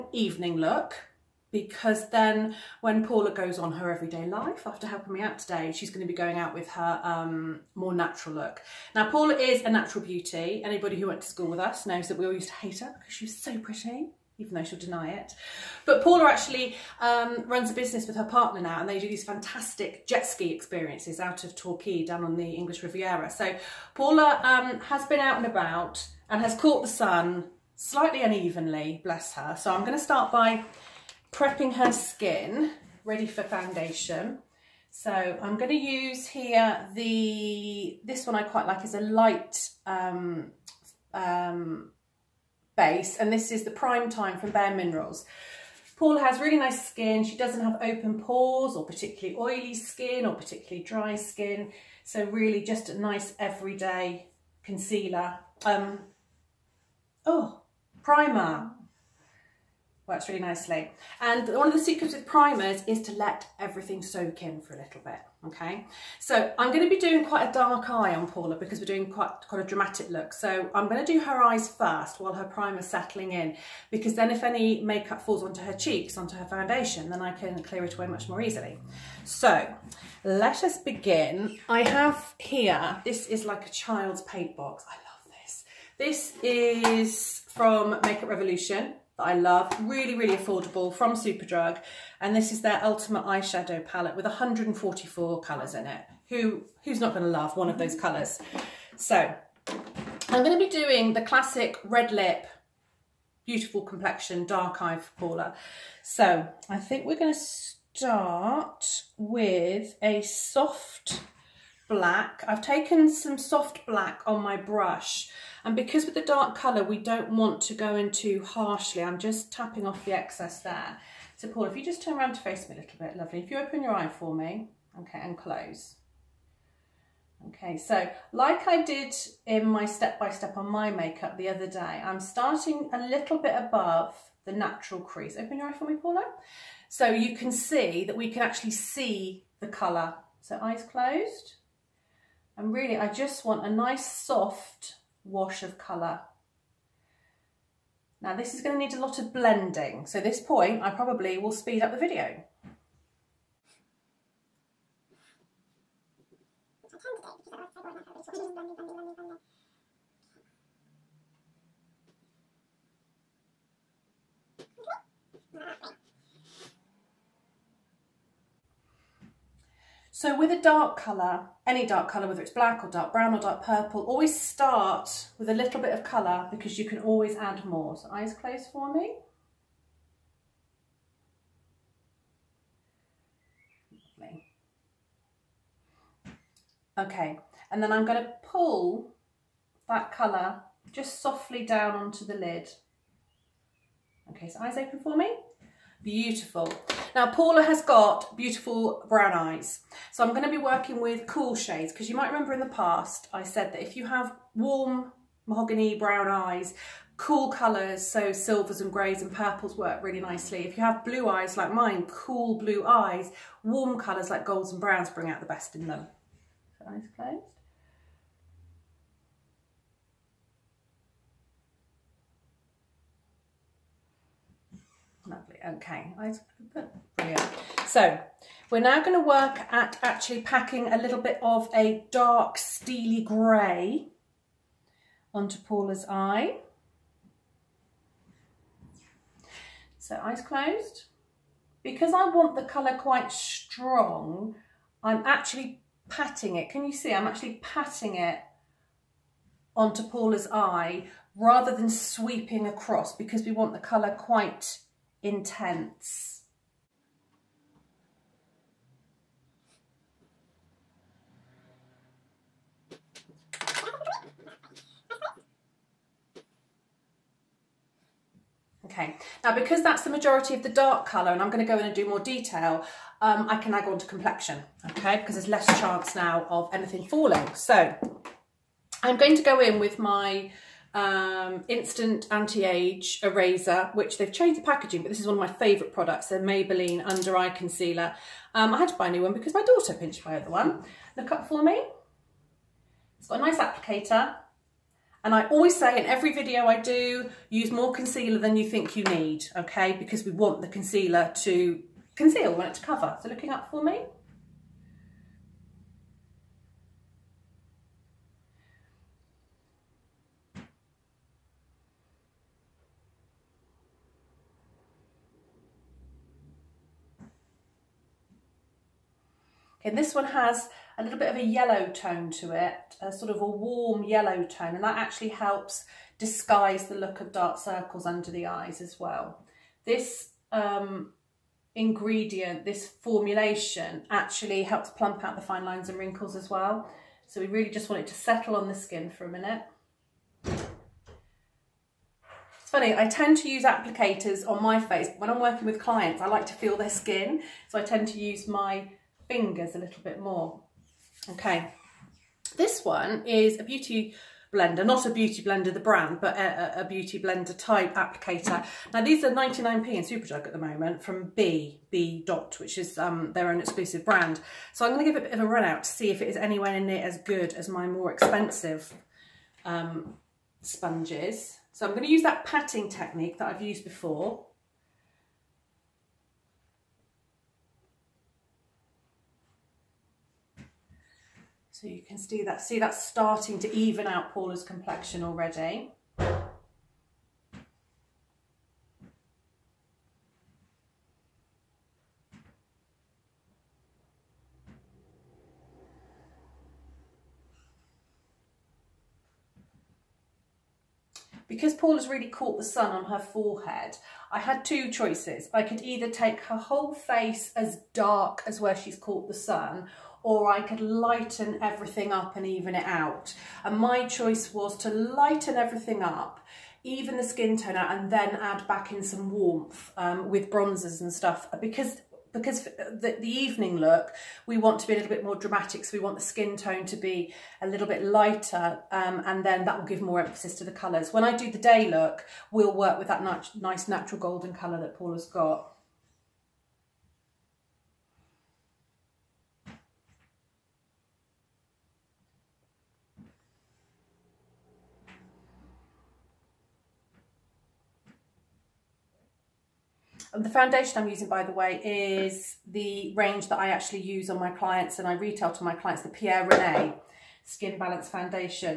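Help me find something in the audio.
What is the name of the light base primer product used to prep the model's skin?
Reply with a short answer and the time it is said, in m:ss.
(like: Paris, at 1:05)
Prime Time, at 0:43.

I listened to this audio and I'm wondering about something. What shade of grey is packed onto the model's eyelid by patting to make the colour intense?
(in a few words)
dark steely grey.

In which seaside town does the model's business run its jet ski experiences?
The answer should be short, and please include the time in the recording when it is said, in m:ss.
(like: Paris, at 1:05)
Torquay, at 0:21.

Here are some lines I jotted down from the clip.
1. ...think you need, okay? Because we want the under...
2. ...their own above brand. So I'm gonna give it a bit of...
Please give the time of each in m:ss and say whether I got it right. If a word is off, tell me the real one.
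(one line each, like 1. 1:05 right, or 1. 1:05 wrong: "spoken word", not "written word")
1. 4:58 wrong: "concealer", not "under"
2. 6:03 wrong: "exclusive", not "above".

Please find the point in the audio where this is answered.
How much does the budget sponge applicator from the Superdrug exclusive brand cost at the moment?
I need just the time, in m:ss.
5:59.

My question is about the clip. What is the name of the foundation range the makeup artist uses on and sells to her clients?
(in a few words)
Pierre Rene Skin Balance Foundation.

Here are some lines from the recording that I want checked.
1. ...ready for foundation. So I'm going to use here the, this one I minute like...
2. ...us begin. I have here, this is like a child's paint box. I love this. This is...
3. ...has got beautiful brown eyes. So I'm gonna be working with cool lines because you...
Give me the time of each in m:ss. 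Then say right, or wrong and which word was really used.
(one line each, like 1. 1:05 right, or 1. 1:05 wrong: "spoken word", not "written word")
1. 0:33 wrong: "quite", not "minute"
2. 1:20 right
3. 3:17 wrong: "shades", not "lines".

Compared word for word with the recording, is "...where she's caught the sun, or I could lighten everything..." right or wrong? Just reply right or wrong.
right.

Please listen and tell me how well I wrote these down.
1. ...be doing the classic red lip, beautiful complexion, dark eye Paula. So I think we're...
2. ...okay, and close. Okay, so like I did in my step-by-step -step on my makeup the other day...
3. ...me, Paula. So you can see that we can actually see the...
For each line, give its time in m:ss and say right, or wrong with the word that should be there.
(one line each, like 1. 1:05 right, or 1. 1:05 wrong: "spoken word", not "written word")
1. 1:40 right
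2. 2:05 right
3. 2:15 right.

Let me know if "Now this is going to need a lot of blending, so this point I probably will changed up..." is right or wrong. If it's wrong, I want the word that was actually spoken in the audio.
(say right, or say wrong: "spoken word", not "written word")
wrong: "speed", not "changed".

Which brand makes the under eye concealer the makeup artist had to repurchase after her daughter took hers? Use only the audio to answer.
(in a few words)
Maybelline.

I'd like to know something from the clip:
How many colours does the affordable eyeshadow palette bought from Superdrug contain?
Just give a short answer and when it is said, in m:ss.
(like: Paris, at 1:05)
144, at 1:34.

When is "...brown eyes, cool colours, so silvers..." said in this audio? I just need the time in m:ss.
3:25.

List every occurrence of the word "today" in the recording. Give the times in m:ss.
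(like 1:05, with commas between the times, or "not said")
0:05.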